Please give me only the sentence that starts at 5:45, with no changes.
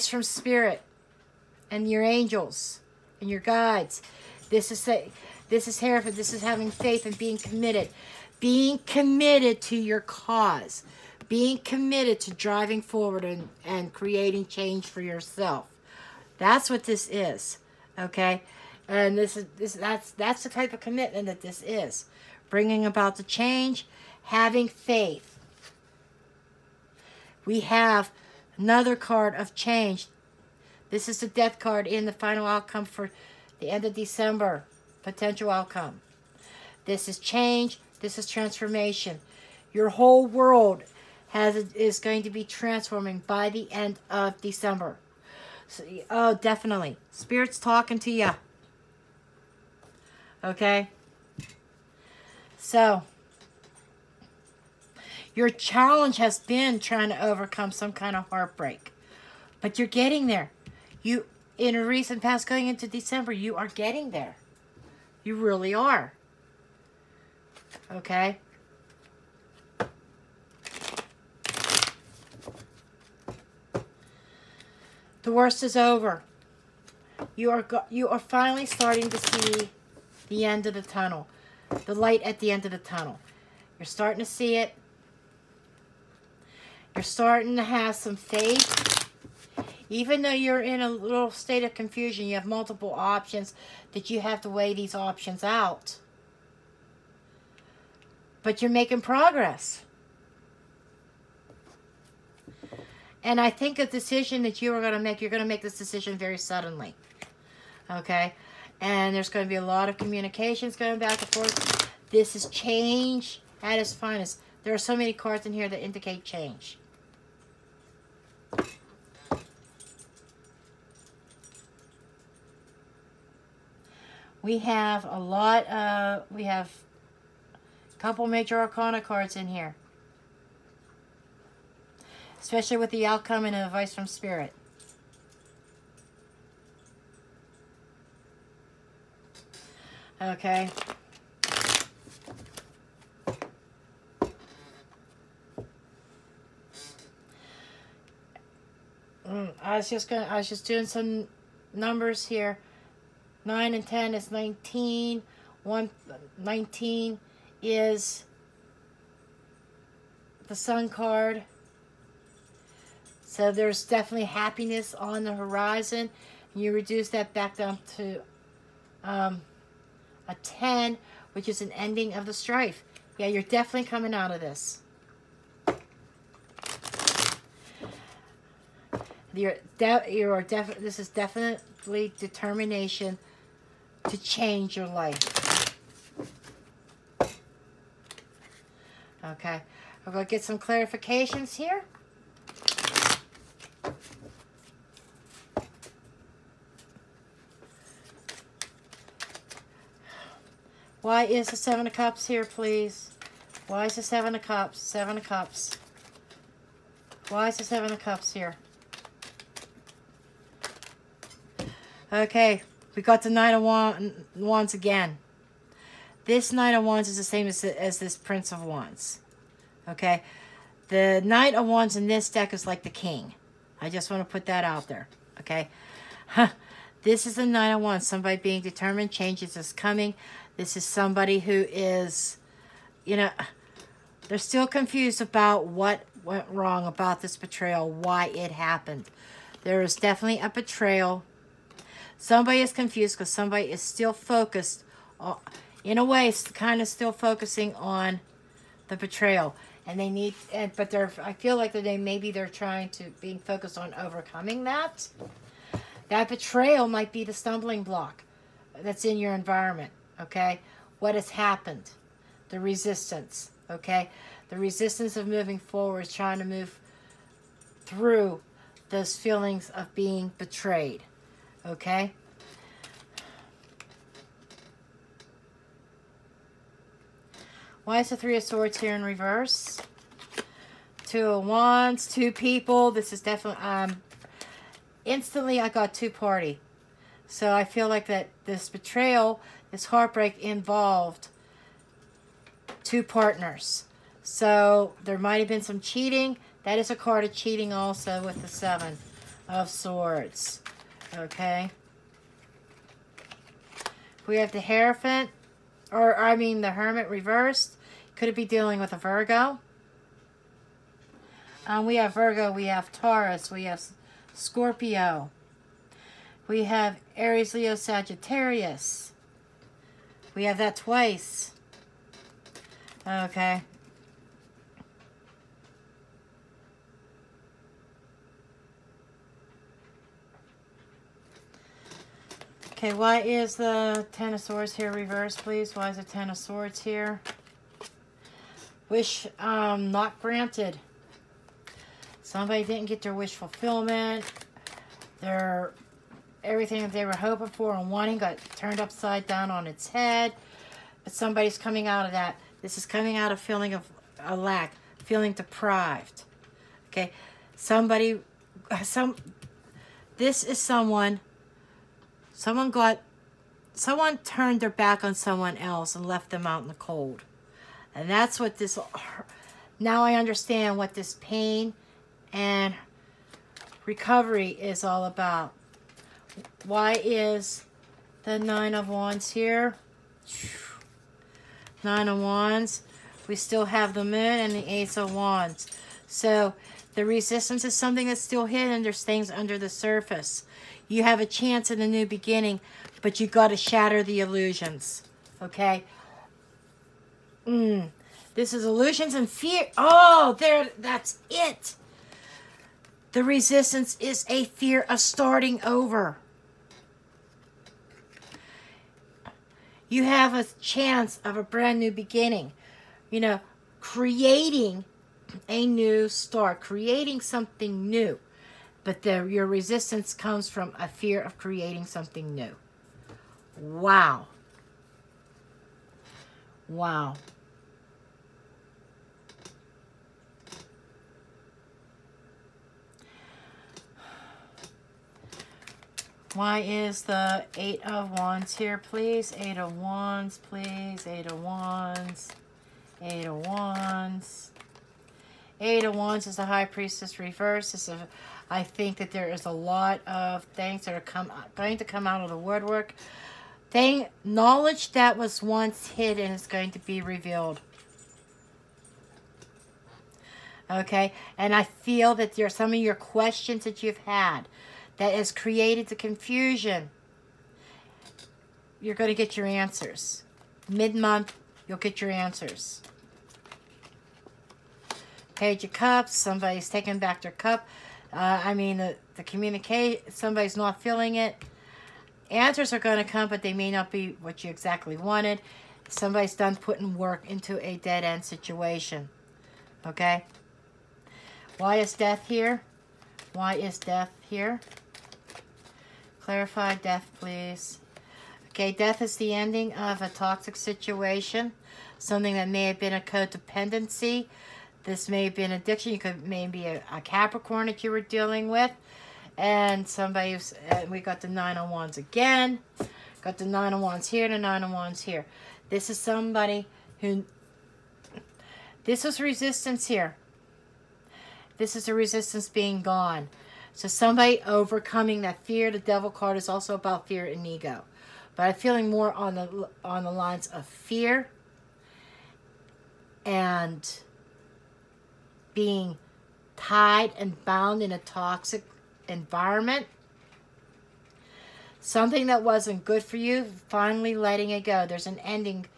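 Their everything that they were hoping for and wanting got turned upside down on its head.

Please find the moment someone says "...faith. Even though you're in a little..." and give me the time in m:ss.
1:28.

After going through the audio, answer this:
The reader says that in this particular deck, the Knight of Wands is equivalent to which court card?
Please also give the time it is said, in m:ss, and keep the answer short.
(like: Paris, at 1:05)
The King, at 3:42.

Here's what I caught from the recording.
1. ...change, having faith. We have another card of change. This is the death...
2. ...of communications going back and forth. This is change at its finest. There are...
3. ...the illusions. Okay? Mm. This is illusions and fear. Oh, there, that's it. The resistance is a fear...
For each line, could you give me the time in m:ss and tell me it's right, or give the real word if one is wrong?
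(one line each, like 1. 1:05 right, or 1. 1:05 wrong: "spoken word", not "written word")
1. 0:23 right
2. 1:49 right
3. 6:34 right.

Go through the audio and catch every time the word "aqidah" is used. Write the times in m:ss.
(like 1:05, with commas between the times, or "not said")
not said.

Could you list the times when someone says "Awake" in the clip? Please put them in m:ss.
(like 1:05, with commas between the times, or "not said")
not said.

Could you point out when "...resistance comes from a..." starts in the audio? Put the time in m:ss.
6:59.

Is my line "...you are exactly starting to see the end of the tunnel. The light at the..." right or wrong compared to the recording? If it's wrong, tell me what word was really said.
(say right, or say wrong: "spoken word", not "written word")
wrong: "finally", not "exactly".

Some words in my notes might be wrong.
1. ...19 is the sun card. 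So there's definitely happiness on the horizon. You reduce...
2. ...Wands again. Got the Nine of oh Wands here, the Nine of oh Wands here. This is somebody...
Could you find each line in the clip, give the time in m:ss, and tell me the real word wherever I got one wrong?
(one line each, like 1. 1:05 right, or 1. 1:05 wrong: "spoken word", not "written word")
1. 2:36 right
2. 8:31 right.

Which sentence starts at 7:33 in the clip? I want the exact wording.
Thing, knowledge that was once hidden is going to be revealed okay?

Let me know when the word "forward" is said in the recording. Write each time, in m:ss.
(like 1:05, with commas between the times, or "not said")
0:12, 4:25.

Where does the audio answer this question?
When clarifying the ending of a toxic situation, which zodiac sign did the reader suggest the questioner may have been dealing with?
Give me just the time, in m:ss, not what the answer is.
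8:27.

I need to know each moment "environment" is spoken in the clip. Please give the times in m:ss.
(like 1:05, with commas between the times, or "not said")
4:19, 8:59.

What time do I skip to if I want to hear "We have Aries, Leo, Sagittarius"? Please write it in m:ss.
5:16.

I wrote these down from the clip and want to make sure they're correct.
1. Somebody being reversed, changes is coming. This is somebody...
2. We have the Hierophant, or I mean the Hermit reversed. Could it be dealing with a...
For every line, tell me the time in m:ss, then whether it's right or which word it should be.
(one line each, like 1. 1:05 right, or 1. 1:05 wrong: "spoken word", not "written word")
1. 3:48 wrong: "determined", not "reversed"
2. 5:04 right.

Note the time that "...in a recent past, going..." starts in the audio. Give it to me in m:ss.
1:01.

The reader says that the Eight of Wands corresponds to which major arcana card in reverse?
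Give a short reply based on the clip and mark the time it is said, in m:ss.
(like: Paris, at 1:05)
High Priestess, at 7:26.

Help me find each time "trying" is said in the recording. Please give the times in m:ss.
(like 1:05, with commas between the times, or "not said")
0:56, 4:12, 4:26.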